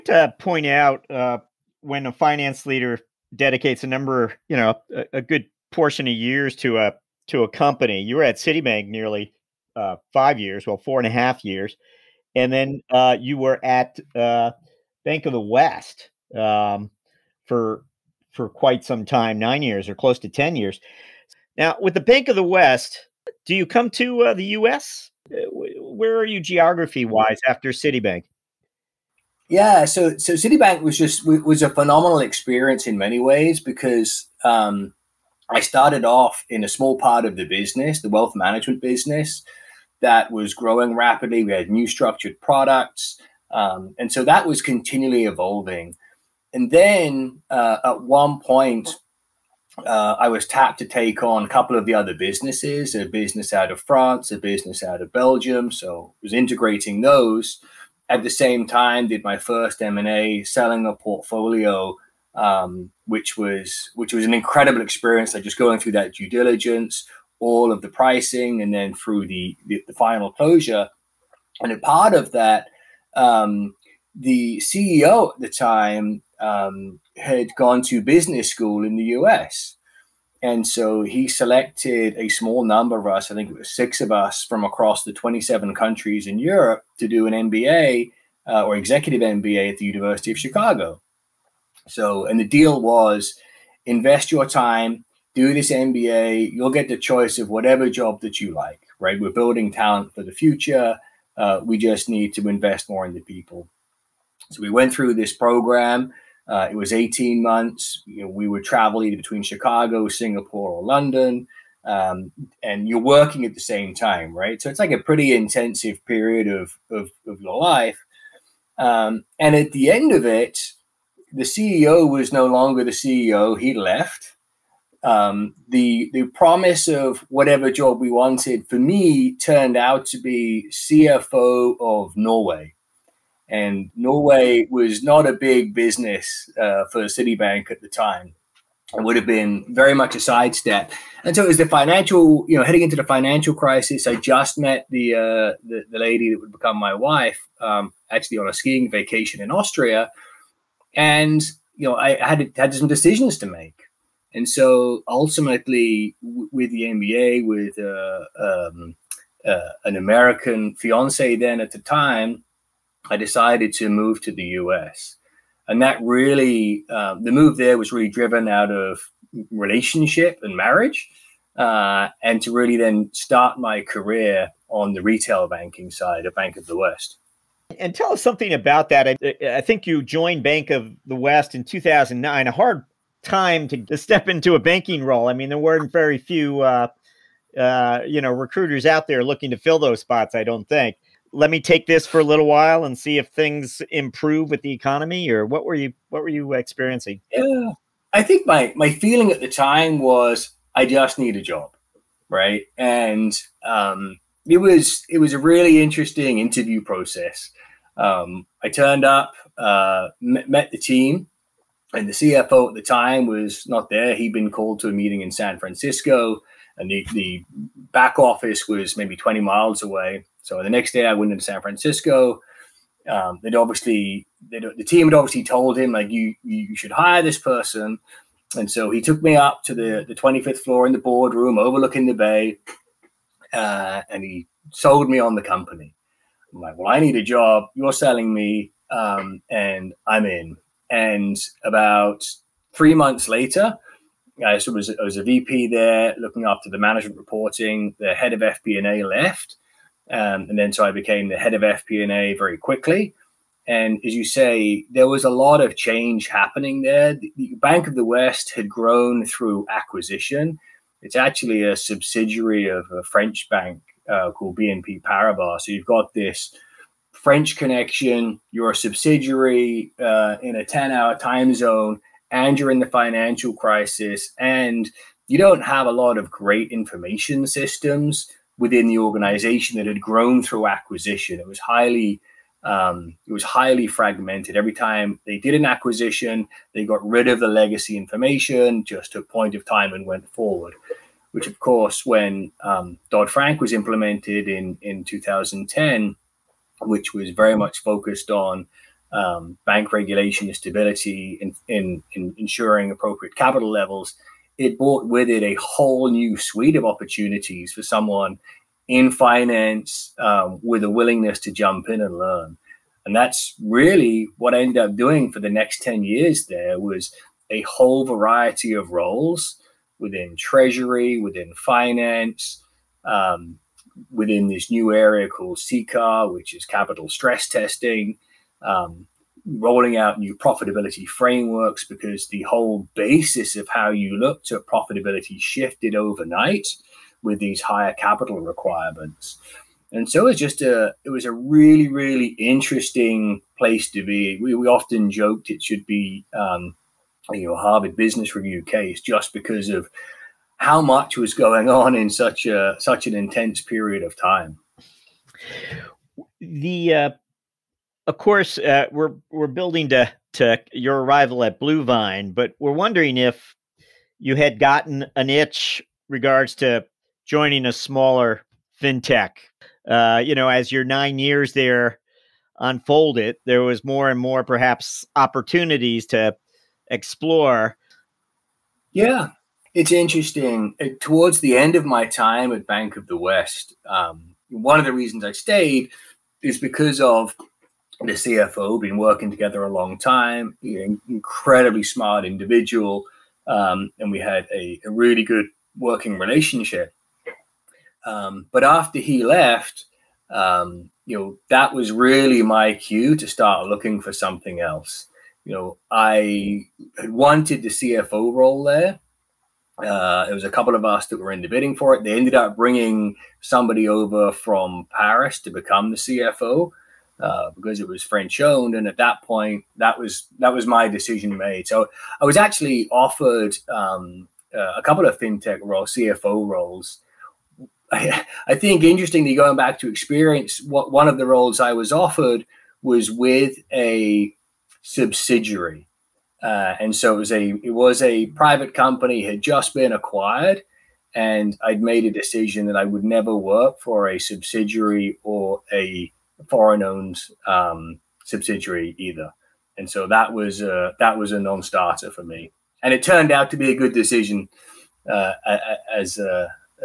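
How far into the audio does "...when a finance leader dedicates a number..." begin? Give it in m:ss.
0:01.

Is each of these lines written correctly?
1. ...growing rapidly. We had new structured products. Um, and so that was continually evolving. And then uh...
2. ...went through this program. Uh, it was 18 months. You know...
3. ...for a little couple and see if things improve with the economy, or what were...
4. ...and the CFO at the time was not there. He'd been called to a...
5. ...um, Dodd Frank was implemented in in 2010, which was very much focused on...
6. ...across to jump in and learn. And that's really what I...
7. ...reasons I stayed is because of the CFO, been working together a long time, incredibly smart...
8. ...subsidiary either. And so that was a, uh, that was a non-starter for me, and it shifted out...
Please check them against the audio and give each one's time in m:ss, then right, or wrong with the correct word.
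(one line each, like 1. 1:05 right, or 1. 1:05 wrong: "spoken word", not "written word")
1. 0:40 right
2. 1:44 right
3. 3:12 wrong: "while", not "couple"
4. 3:31 right
5. 4:52 right
6. 5:10 wrong: "willingness", not "across"
7. 6:24 right
8. 7:28 wrong: "turned", not "shifted".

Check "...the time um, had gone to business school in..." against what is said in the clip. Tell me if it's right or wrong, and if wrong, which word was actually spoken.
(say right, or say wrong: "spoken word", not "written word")
right.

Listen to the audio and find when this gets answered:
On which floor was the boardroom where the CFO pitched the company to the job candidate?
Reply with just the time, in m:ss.
3:50.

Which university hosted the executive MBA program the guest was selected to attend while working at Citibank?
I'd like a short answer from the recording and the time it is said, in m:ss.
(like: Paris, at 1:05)
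University of Chicago, at 1:29.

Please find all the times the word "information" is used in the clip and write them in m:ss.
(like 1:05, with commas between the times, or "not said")
4:36, 4:47.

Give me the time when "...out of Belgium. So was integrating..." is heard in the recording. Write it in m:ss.
0:54.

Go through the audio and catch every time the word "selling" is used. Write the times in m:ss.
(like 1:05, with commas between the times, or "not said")
1:00, 3:57.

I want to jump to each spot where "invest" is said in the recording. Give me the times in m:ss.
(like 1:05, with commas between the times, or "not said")
1:33, 1:42.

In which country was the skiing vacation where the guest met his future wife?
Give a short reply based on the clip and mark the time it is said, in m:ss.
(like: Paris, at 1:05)
Austria, at 2:29.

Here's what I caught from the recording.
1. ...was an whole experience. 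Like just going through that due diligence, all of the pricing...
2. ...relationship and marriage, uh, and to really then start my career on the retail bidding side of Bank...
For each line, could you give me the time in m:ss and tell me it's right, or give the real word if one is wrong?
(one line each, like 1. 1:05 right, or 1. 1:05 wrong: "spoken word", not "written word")
1. 1:04 wrong: "incredible", not "whole"
2. 2:49 wrong: "banking", not "bidding".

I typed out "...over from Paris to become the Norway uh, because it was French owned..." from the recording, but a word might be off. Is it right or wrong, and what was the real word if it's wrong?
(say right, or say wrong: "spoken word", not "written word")
wrong: "CFO", not "Norway".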